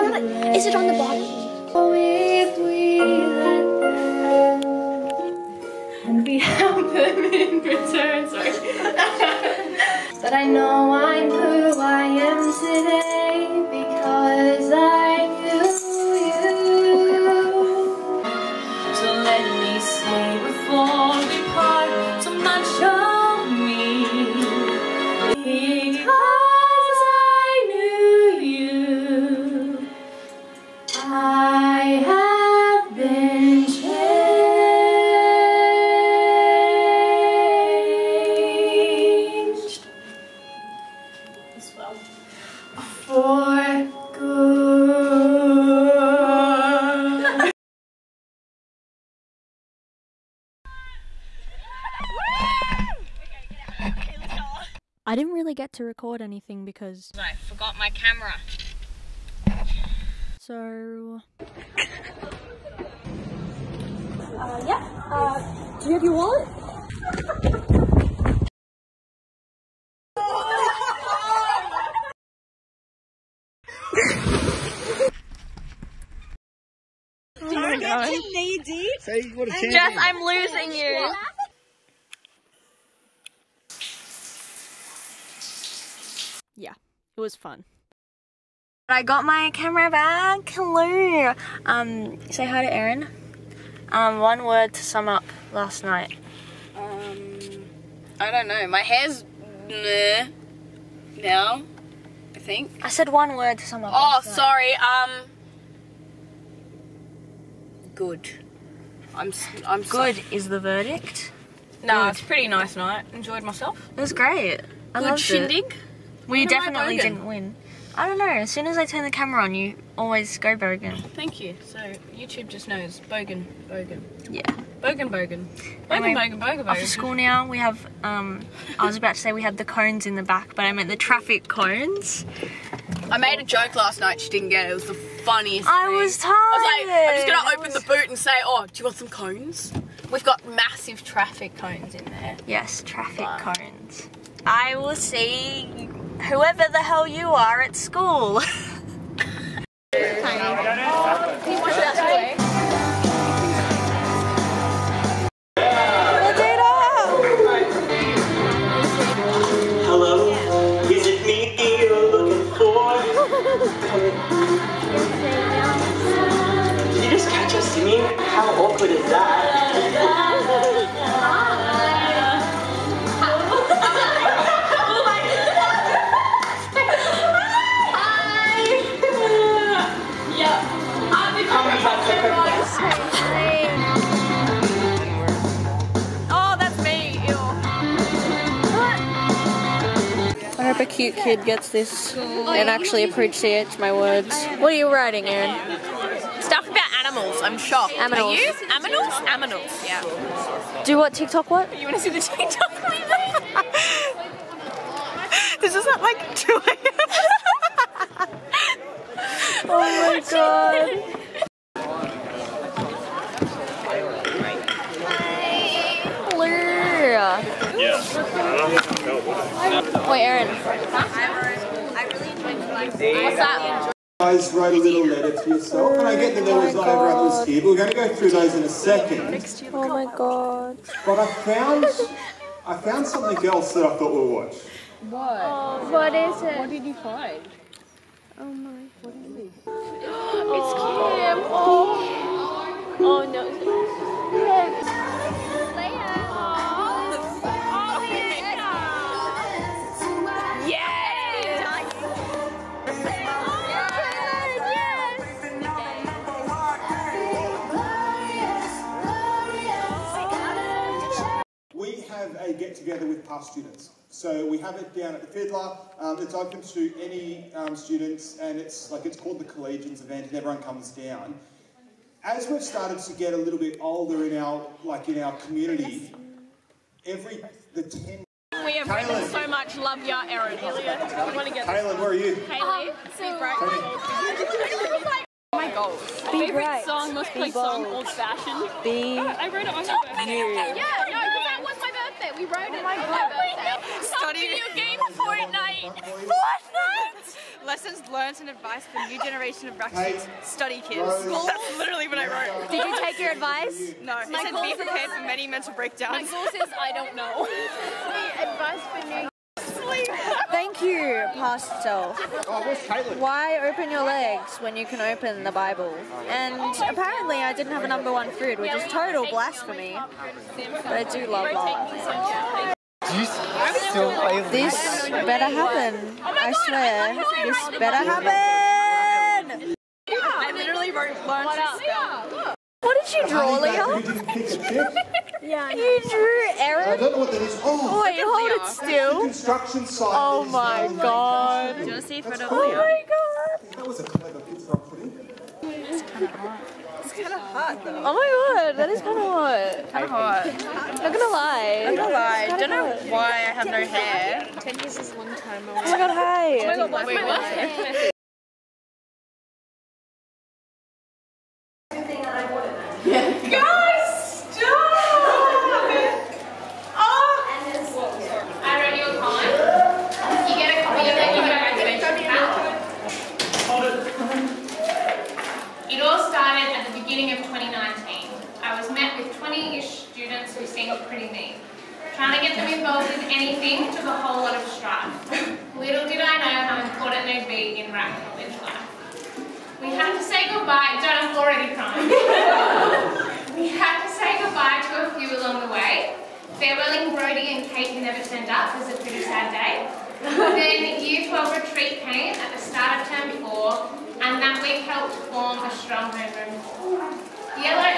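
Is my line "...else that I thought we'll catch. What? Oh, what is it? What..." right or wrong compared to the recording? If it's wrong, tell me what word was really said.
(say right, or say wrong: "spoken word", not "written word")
wrong: "watch", not "catch".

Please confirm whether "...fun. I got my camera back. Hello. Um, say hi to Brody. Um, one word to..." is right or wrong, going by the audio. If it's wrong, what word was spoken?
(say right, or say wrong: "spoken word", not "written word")
wrong: "Erin", not "Brody".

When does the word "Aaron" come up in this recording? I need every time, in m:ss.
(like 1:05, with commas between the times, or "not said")
3:40, 4:40, 5:36.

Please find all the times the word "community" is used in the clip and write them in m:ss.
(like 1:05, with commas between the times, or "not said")
4:35.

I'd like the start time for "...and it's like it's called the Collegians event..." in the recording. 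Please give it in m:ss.
4:28.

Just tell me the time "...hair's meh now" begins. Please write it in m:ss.
1:38.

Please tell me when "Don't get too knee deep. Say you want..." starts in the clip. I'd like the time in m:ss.
1:17.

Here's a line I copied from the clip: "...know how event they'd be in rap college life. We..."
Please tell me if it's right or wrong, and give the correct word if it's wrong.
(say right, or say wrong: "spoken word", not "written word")
wrong: "important", not "event".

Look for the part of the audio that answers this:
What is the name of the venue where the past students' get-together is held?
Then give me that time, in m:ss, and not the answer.
4:25.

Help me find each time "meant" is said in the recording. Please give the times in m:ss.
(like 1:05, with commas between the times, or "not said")
2:10.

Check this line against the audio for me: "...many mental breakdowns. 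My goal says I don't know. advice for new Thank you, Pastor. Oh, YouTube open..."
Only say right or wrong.
wrong.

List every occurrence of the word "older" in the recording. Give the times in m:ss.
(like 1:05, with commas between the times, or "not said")
4:33.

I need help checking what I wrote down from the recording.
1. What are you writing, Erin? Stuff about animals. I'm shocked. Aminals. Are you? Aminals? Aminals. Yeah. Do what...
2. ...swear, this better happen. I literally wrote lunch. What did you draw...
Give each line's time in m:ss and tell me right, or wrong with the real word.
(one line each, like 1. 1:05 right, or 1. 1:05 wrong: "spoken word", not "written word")
1. 3:14 right
2. 5:26 right.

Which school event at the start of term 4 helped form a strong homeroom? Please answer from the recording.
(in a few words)
Year 12 retreat.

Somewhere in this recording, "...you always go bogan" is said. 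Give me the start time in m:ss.
1:59.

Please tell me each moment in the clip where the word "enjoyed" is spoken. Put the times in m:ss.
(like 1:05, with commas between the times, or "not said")
1:53, 3:42.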